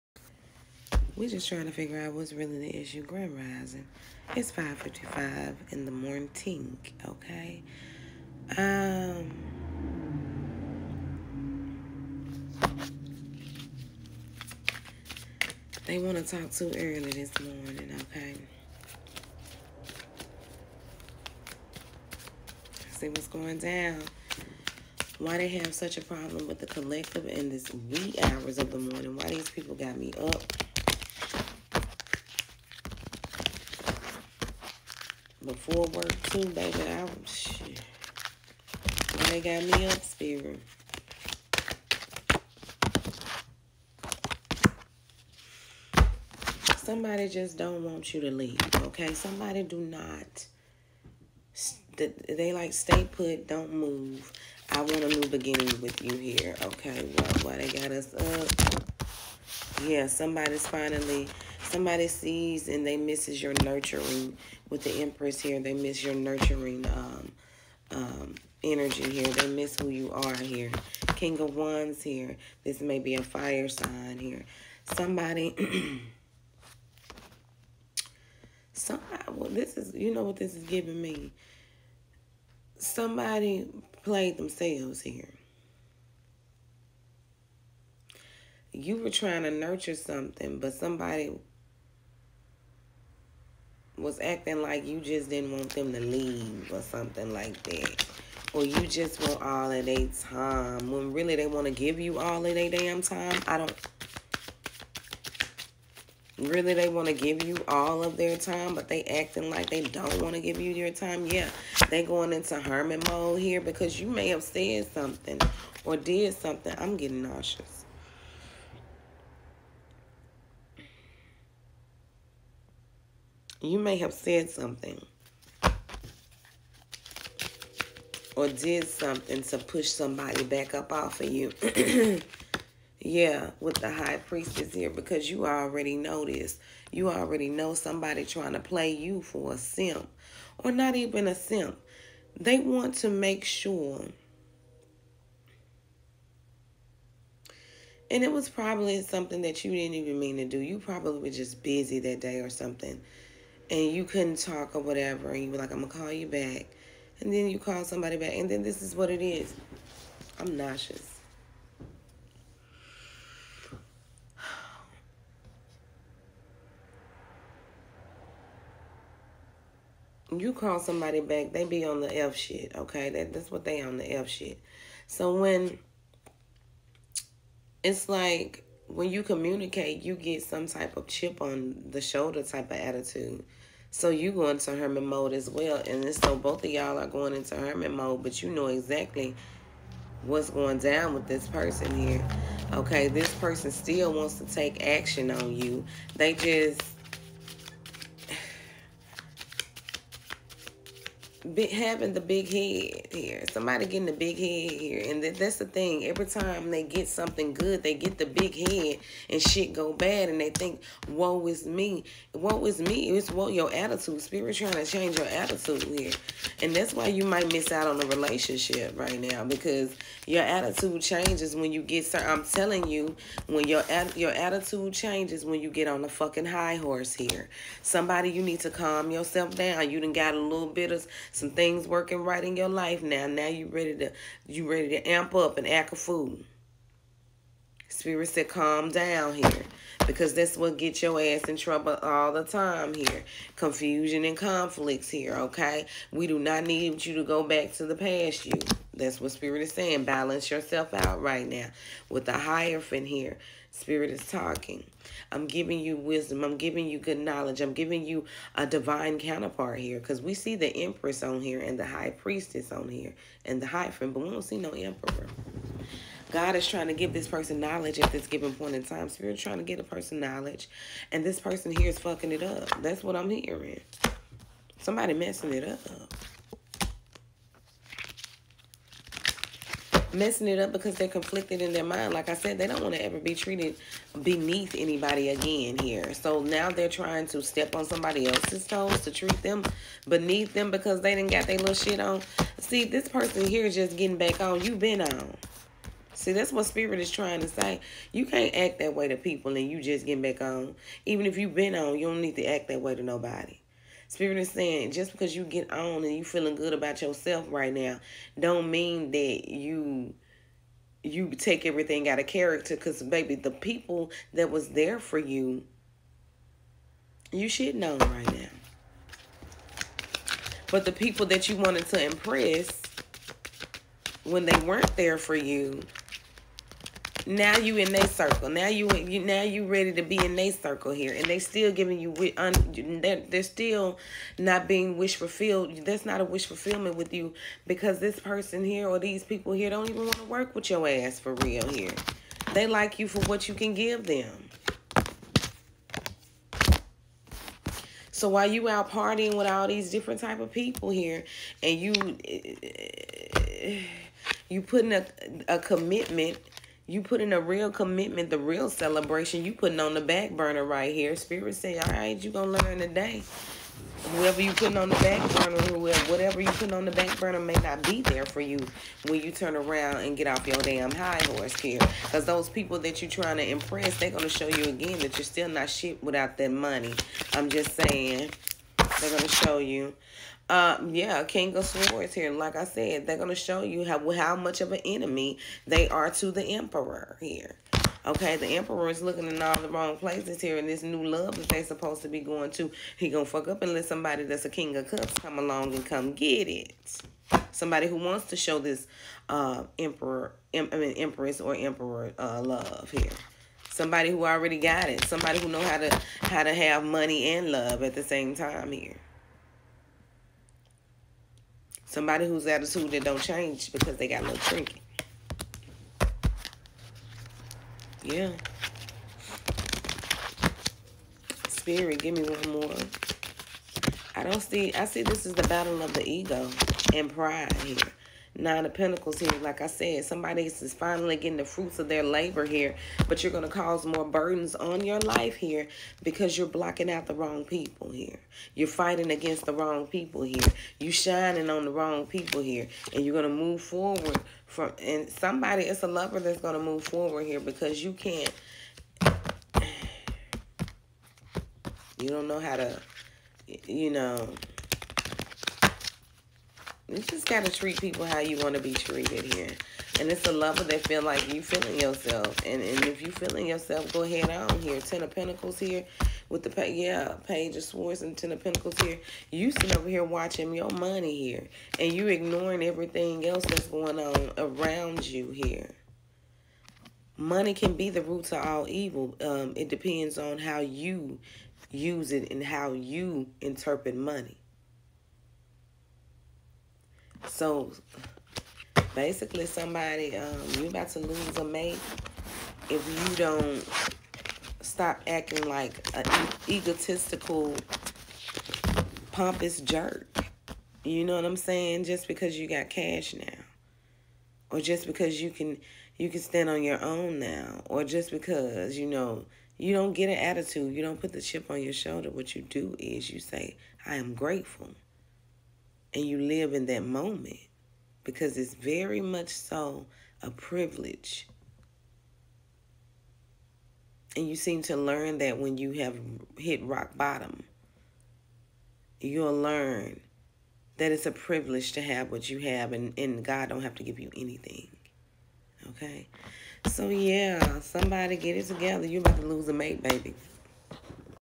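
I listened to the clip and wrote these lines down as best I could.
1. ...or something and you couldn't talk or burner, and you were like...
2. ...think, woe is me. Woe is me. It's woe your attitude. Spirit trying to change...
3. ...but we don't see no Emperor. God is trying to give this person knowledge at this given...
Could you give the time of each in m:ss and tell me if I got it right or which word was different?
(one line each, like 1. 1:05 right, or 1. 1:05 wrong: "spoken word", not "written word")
1. 2:32 wrong: "whatever", not "burner"
2. 3:30 right
3. 4:24 right.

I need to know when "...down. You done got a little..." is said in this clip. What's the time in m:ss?
3:49.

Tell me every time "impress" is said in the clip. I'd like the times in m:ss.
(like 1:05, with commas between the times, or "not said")
5:22, 6:13.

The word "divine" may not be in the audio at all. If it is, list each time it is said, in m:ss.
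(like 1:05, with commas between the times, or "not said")
4:18.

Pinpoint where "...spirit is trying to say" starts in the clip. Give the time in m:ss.
4:56.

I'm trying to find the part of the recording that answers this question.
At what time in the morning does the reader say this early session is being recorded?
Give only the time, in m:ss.
0:04.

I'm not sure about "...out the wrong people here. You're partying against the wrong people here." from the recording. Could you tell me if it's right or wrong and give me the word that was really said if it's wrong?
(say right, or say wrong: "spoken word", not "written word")
wrong: "fighting", not "partying".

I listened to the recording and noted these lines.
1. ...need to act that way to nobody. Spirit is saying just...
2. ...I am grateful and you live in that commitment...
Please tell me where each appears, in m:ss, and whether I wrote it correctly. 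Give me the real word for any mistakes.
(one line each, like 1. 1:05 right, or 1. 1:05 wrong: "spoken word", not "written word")
1. 5:02 right
2. 8:33 wrong: "moment", not "commitment".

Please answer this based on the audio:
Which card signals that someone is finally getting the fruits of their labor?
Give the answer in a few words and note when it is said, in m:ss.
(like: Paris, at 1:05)
Nine of Pentacles, at 7:08.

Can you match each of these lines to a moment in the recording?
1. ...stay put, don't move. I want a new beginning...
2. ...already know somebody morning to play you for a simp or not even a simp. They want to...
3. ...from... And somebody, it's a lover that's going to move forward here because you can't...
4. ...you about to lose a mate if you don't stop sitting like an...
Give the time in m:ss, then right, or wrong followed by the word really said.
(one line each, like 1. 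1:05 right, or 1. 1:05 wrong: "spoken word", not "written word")
1. 0:52 right
2. 2:17 wrong: "trying", not "morning"
3. 7:24 right
4. 8:10 wrong: "acting", not "sitting".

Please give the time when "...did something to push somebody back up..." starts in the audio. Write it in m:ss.
2:08.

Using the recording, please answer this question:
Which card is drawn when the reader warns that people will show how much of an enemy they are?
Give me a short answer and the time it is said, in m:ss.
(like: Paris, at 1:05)
King of Swords, at 6:21.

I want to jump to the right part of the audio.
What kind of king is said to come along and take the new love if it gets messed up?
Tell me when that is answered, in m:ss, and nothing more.
6:34.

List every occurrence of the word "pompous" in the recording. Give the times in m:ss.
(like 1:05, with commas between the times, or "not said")
8:19.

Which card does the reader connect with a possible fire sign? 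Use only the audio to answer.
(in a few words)
King of Wands.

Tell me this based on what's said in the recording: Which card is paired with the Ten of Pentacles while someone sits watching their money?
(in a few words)
Page of Swords.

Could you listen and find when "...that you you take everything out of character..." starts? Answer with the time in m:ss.
5:09.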